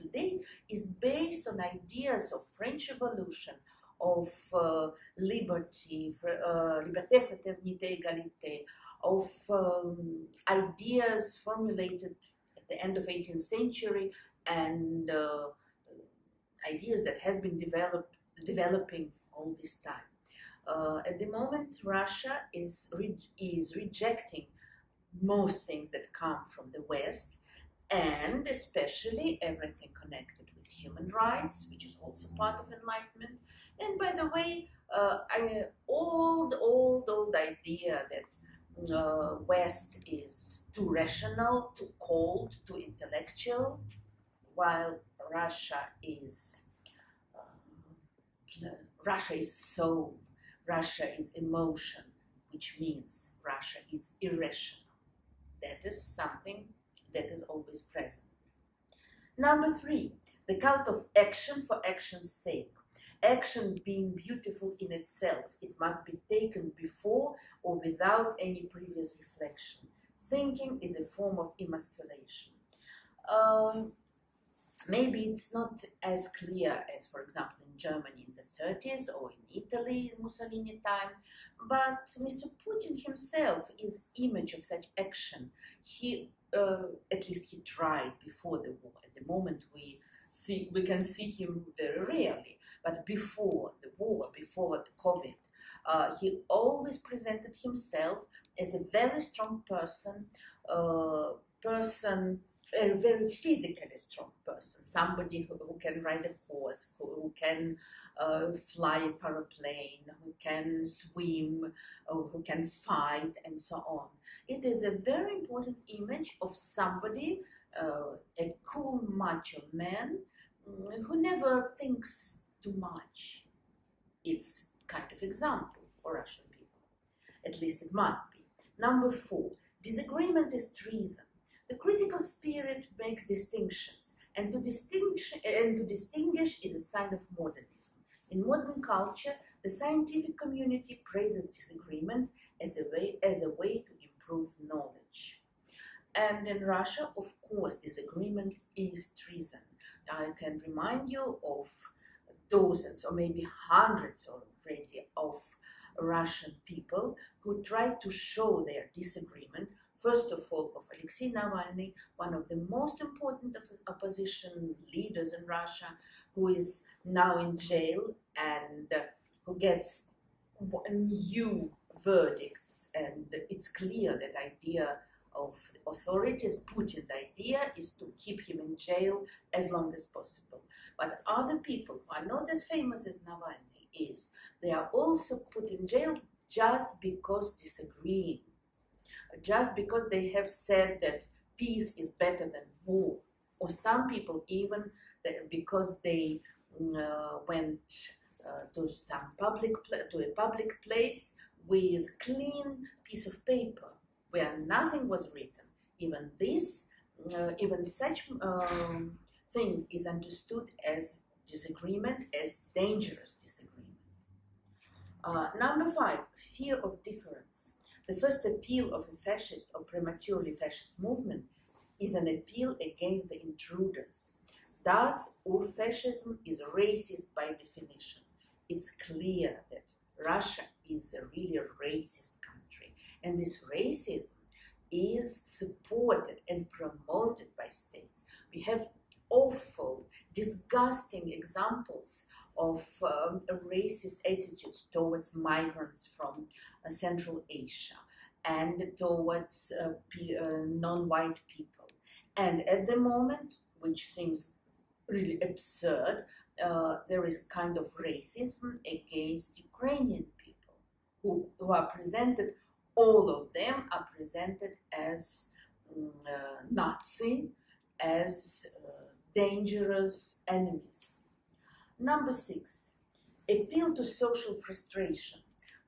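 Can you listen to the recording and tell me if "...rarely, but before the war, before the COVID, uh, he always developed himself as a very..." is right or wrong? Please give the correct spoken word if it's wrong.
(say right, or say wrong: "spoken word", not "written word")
wrong: "presented", not "developed".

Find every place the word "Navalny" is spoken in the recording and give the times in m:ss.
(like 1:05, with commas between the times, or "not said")
2:41, 3:03.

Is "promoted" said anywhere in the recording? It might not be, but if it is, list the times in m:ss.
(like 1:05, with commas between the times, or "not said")
3:56.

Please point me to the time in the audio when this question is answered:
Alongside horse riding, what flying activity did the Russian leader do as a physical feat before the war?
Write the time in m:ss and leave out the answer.
1:48.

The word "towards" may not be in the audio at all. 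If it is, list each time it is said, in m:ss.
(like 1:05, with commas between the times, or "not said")
4:04, 4:08.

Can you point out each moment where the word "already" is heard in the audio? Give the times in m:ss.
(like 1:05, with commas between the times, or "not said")
2:34.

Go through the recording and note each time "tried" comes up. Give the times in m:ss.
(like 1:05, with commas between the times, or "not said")
1:27, 2:37.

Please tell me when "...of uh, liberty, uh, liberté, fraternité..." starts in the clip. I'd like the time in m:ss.
0:03.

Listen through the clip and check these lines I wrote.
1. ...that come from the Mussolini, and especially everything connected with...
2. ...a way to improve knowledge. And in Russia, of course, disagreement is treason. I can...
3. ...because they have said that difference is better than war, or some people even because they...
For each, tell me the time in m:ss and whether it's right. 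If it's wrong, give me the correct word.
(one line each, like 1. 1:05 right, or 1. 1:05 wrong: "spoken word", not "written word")
1. 0:25 wrong: "West", not "Mussolini"
2. 2:23 right
3. 3:09 wrong: "peace", not "difference".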